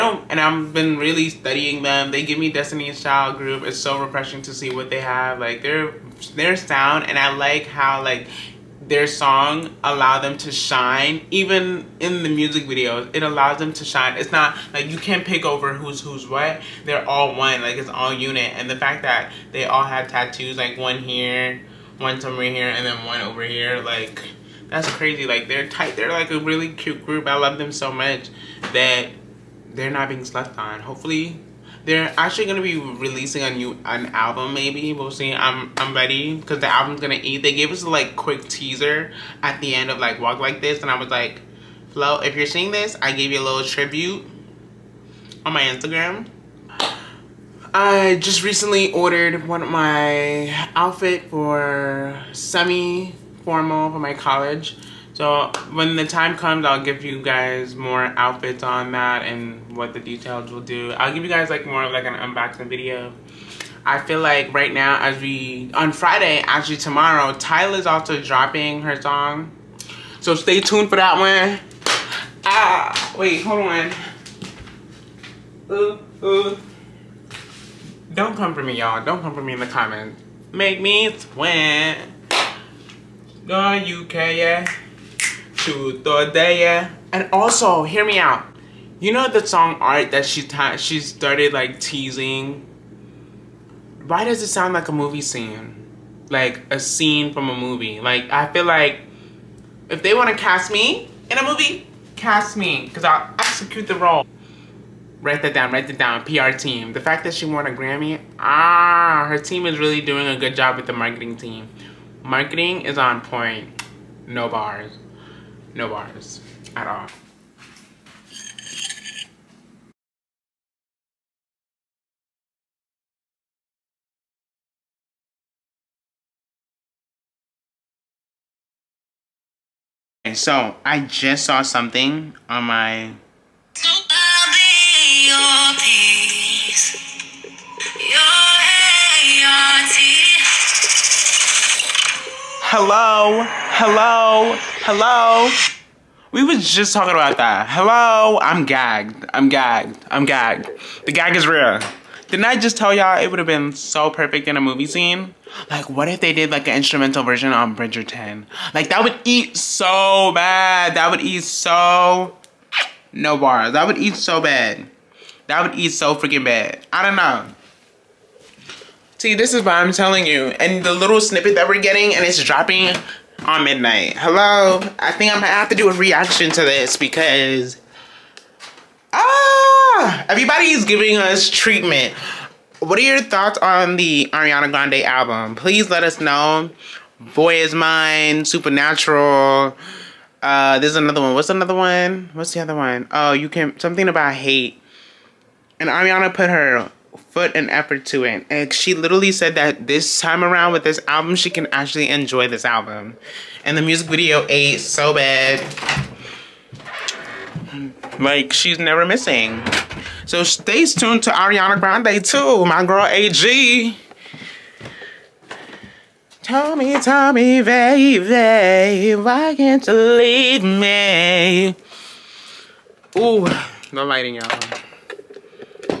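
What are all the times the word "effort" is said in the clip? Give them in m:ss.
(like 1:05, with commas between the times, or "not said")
3:17.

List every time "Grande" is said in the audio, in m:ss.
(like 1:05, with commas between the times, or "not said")
3:04, 3:31.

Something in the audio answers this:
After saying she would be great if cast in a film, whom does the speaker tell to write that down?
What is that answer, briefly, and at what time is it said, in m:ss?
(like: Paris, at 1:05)
PR team, at 1:46.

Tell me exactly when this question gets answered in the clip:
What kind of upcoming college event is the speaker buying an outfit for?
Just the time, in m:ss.
0:52.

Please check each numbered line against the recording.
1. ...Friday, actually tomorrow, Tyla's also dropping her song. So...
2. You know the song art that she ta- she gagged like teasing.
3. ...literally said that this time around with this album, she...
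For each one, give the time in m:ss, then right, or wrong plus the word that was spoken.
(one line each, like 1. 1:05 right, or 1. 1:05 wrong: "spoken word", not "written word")
1. 1:05 right
2. 1:28 wrong: "started", not "gagged"
3. 3:18 right.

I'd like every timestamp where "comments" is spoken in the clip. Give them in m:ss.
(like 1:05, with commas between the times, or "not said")
1:19.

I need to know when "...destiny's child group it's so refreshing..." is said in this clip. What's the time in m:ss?
0:02.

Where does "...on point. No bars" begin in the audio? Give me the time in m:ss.
1:52.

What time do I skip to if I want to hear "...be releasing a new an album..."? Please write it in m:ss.
0:32.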